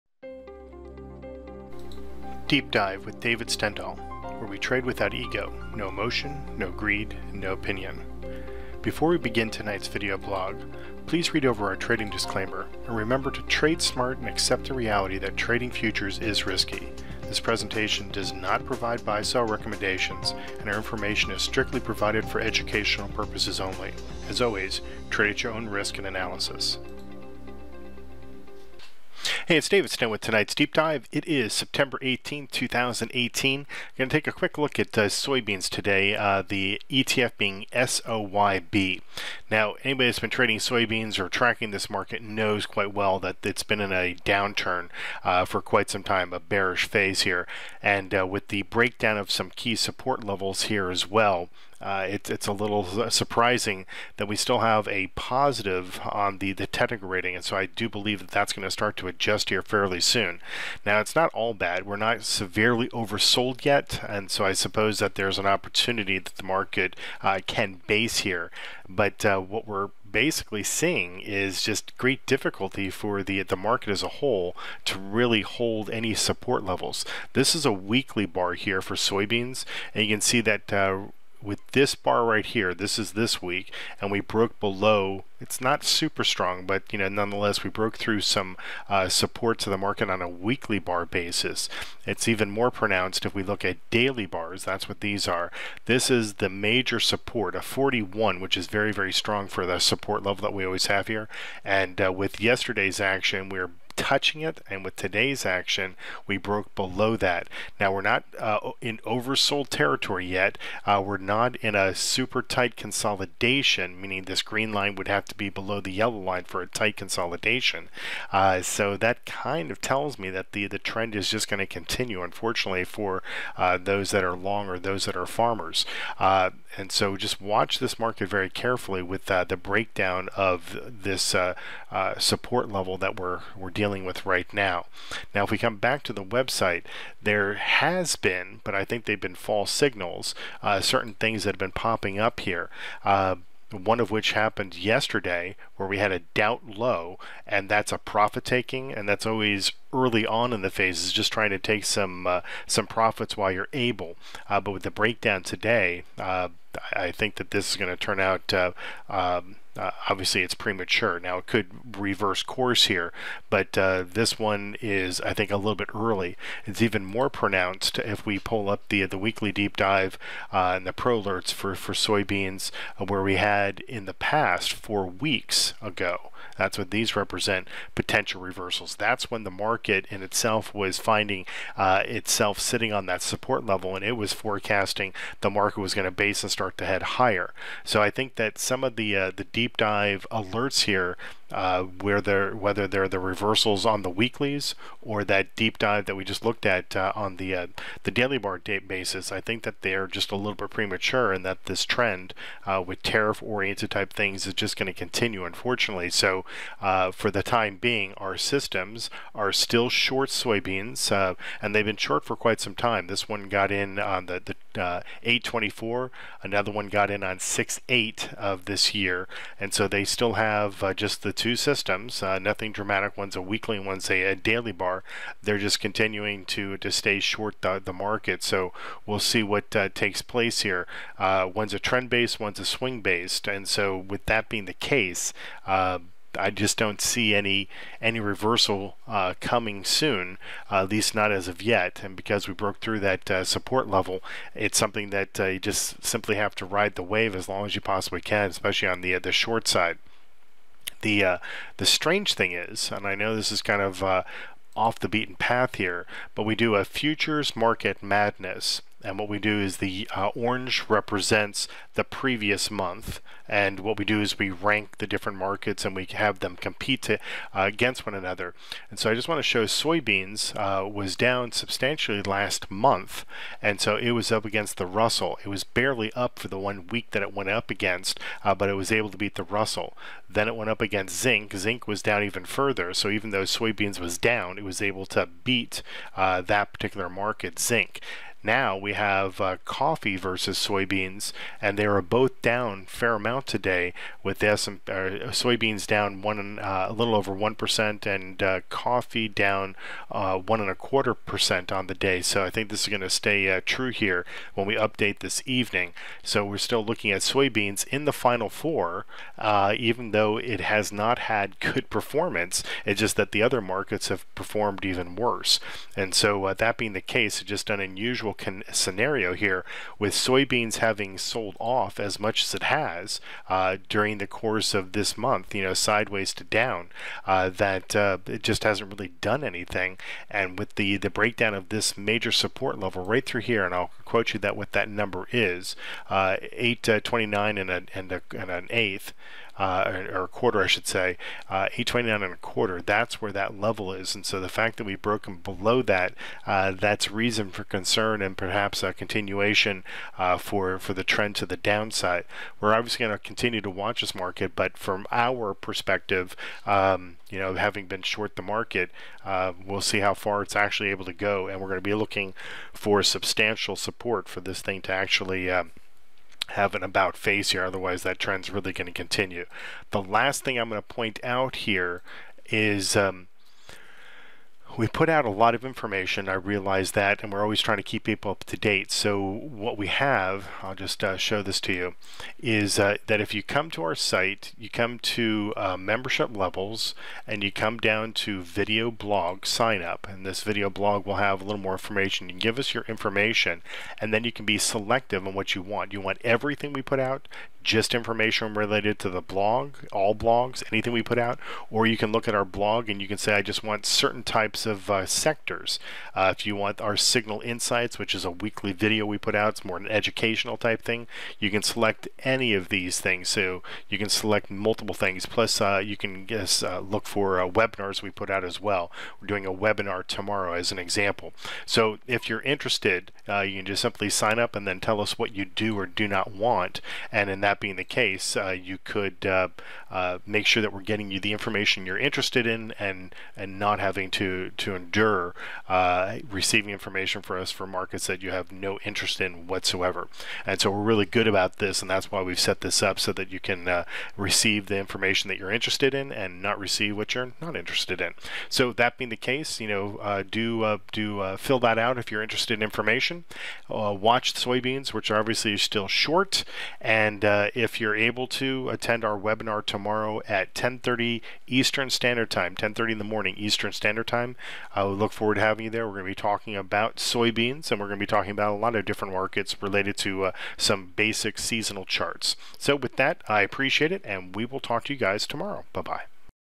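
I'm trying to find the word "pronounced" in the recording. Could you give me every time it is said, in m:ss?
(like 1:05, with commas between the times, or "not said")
1:32, 2:47.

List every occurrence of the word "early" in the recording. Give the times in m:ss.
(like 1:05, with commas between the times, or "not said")
2:29, 2:45.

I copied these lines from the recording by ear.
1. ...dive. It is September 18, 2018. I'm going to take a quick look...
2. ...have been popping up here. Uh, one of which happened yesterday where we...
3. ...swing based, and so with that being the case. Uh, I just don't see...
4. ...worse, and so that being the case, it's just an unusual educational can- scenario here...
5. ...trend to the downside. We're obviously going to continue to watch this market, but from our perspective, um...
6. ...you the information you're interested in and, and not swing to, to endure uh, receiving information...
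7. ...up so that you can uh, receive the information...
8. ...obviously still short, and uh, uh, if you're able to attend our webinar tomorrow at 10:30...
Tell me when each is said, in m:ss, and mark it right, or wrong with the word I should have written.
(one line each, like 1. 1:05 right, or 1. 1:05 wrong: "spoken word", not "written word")
1. 0:30 right
2. 2:21 right
3. 3:52 right
4. 5:15 wrong: "unusual", not "educational"
5. 5:51 right
6. 7:11 wrong: "having", not "swing"
7. 7:22 right
8. 7:35 right.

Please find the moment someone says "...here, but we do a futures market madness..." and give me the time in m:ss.
4:15.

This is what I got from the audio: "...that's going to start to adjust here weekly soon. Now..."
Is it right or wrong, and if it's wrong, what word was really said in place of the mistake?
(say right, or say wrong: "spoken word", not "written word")
wrong: "fairly", not "weekly".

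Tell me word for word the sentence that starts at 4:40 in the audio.
Then it went up against zinc.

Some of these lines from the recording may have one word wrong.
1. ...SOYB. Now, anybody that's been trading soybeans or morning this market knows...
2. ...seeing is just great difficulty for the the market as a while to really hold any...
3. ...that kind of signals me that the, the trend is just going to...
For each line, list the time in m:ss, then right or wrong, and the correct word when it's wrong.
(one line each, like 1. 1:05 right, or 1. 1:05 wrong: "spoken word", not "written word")
1. 0:37 wrong: "tracking", not "morning"
2. 1:10 wrong: "whole", not "while"
3. 1:58 wrong: "tells", not "signals".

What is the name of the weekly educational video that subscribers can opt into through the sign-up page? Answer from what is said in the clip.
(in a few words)
Signal Insights.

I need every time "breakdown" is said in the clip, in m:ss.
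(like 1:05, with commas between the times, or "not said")
0:48, 2:09, 2:34, 5:31.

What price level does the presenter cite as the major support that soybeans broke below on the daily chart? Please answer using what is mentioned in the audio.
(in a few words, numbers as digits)
829 1/4.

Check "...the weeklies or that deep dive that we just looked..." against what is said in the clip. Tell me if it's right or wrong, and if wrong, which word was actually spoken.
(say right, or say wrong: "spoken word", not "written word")
right.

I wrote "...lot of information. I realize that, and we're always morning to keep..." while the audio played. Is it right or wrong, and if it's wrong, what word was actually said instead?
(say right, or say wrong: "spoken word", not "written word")
wrong: "trying", not "morning".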